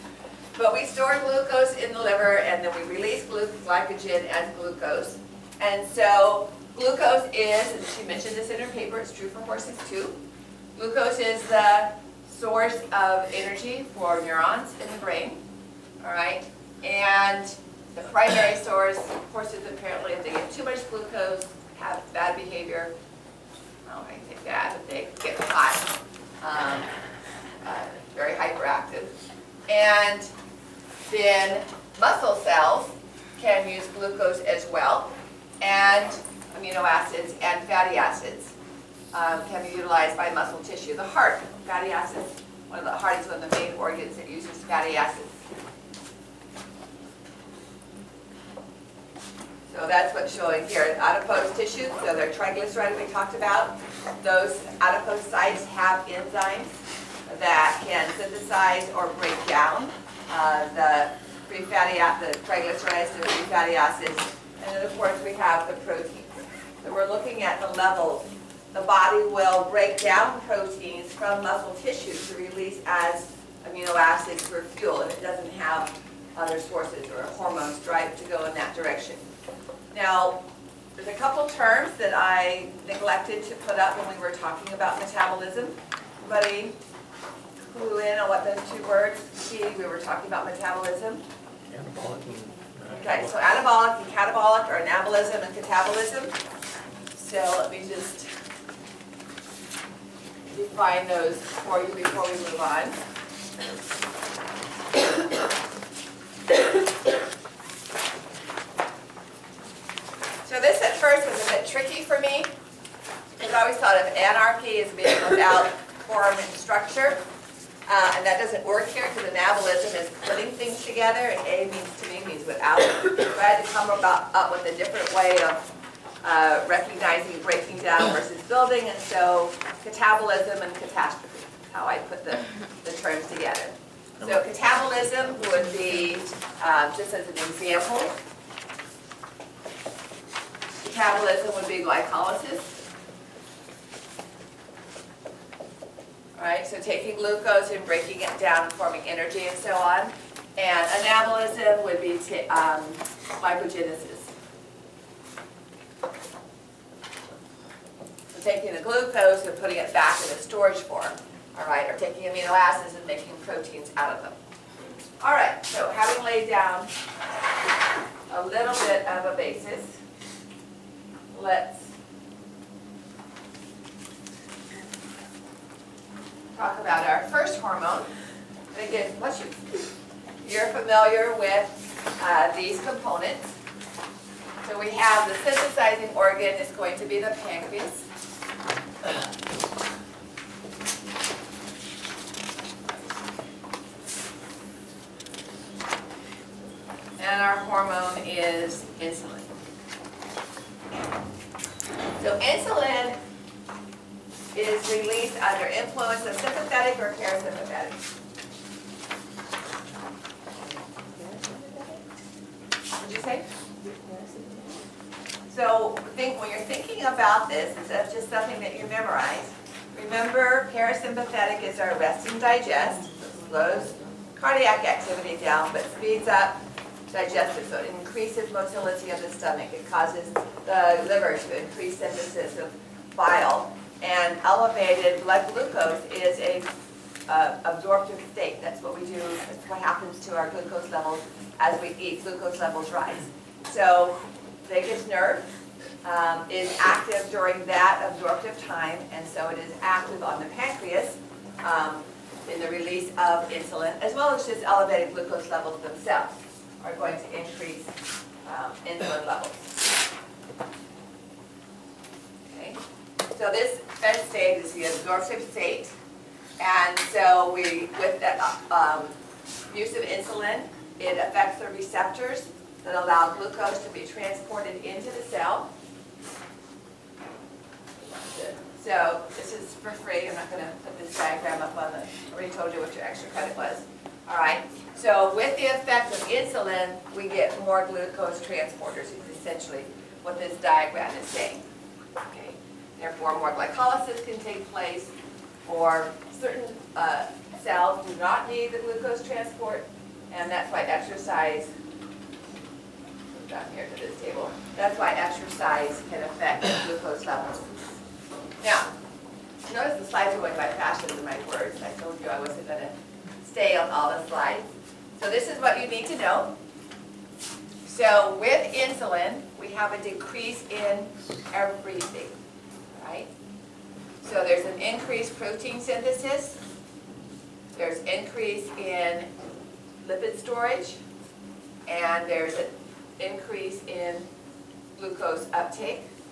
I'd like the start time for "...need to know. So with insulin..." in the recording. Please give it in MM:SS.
05:15.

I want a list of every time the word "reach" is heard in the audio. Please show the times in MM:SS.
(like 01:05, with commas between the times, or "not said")
not said.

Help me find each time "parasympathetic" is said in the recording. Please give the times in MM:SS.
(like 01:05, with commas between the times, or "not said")
03:27, 03:40.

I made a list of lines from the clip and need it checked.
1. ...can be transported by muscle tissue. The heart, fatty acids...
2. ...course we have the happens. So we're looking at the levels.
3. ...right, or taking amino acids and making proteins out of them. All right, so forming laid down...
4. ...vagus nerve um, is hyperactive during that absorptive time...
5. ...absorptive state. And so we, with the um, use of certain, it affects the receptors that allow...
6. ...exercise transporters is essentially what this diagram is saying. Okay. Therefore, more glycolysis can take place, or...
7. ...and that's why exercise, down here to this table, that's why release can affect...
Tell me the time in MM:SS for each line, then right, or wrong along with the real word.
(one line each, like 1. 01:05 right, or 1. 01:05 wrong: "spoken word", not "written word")
1. 00:39 wrong: "utilized", not "transported"
2. 01:04 wrong: "proteins", not "happens"
3. 02:41 wrong: "having", not "forming"
4. 04:04 wrong: "active", not "hyperactive"
5. 04:24 wrong: "insulin", not "certain"
6. 04:47 wrong: "glucose", not "exercise"
7. 05:00 wrong: "exercise", not "release".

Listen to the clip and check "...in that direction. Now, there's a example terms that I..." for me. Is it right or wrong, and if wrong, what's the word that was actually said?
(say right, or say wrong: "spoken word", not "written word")
wrong: "couple", not "example".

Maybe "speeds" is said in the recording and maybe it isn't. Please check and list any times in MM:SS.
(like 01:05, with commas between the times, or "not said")
03:45.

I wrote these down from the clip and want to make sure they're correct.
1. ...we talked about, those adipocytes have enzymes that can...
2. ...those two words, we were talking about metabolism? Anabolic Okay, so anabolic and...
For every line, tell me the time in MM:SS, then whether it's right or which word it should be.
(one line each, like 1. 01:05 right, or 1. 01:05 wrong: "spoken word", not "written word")
1. 00:52 right
2. 01:28 right.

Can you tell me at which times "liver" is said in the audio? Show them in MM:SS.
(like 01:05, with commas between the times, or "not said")
00:02, 03:51.